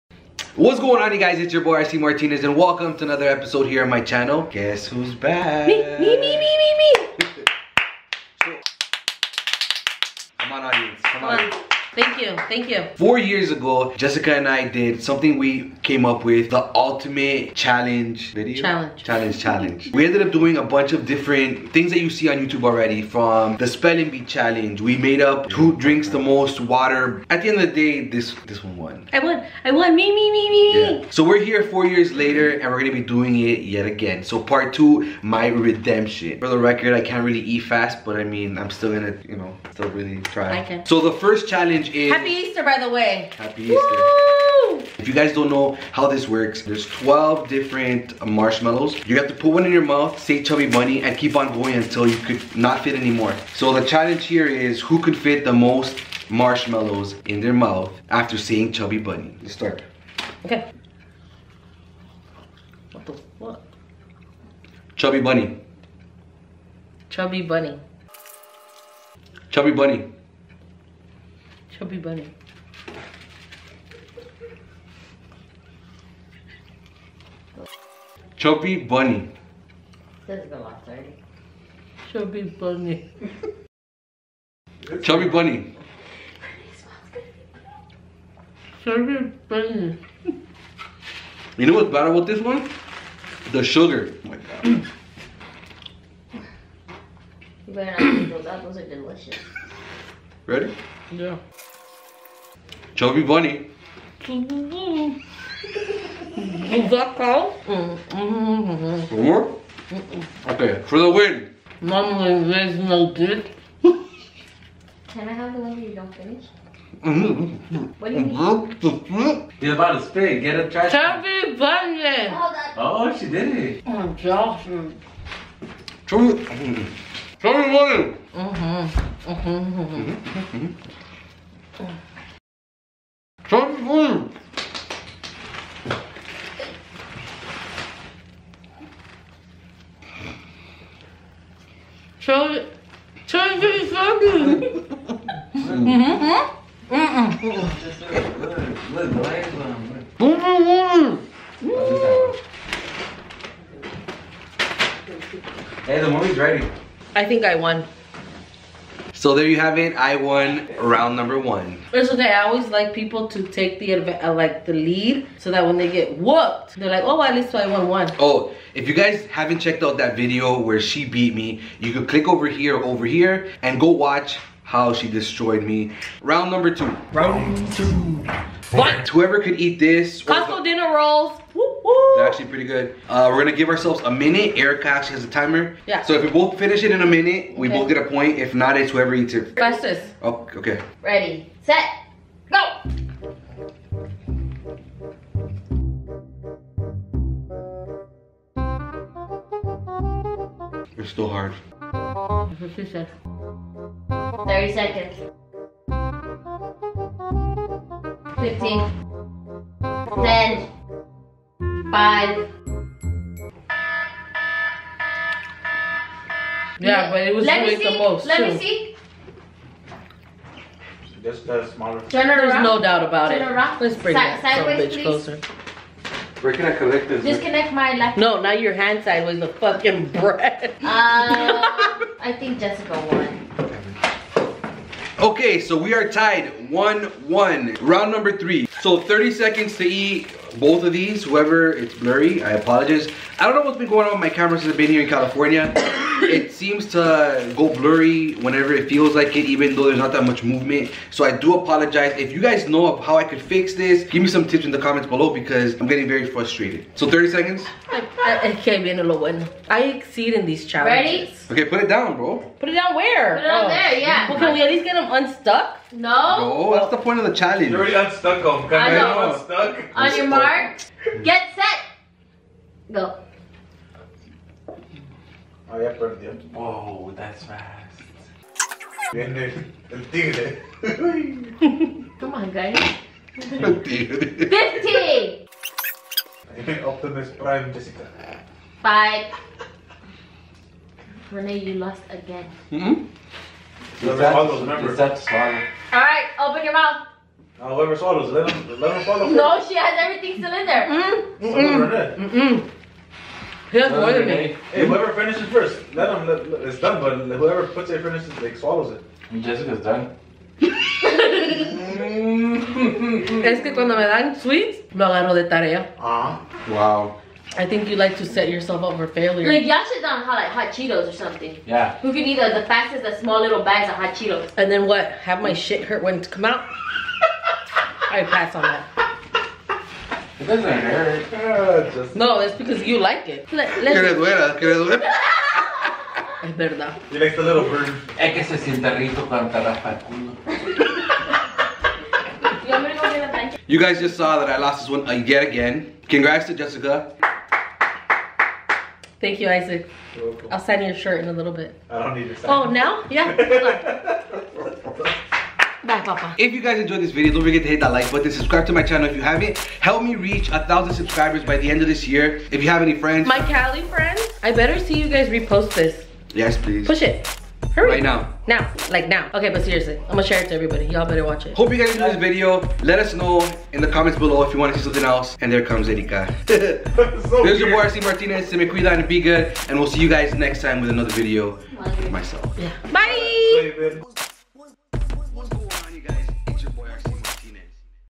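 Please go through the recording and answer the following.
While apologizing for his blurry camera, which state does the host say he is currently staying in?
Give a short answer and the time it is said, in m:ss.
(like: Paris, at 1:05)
California, at 4:05.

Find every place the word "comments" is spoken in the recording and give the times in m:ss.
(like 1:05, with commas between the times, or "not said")
4:14, 6:13.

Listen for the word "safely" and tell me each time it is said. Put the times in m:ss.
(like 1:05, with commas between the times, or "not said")
not said.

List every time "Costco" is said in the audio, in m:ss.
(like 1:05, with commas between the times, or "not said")
3:00.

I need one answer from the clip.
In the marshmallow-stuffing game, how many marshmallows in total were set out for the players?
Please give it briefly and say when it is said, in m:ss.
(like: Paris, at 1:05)
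12, at 0:46.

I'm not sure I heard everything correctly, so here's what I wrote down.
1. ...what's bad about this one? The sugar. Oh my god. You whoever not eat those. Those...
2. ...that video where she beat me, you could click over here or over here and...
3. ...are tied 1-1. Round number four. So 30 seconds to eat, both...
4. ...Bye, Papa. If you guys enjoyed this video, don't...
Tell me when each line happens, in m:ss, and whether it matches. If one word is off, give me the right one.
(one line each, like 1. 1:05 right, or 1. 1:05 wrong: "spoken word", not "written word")
1. 1:31 wrong: "better", not "whoever"
2. 2:49 right
3. 3:55 wrong: "three", not "four"
4. 5:55 right.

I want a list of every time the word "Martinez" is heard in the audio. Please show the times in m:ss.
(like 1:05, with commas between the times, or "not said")
0:01, 6:18.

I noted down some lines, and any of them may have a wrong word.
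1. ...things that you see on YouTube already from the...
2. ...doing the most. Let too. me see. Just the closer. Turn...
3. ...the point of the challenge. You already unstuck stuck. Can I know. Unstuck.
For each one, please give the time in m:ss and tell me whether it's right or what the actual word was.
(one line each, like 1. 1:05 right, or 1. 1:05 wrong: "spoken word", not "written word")
1. 0:21 right
2. 3:37 wrong: "smaller", not "closer"
3. 4:26 right.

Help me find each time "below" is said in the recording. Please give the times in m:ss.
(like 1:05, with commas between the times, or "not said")
4:15, 6:14.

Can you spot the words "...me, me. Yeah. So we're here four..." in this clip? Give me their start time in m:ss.
0:30.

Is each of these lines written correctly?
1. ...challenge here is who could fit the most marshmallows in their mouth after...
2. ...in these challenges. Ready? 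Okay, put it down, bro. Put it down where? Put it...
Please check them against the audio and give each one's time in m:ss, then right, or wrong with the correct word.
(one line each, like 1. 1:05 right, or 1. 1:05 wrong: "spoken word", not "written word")
1. 0:53 right
2. 4:20 right.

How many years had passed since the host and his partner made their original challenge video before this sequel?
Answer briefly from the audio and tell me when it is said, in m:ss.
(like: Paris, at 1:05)
4, at 0:12.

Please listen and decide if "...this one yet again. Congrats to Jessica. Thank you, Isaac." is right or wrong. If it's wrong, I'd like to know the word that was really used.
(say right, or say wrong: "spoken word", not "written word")
right.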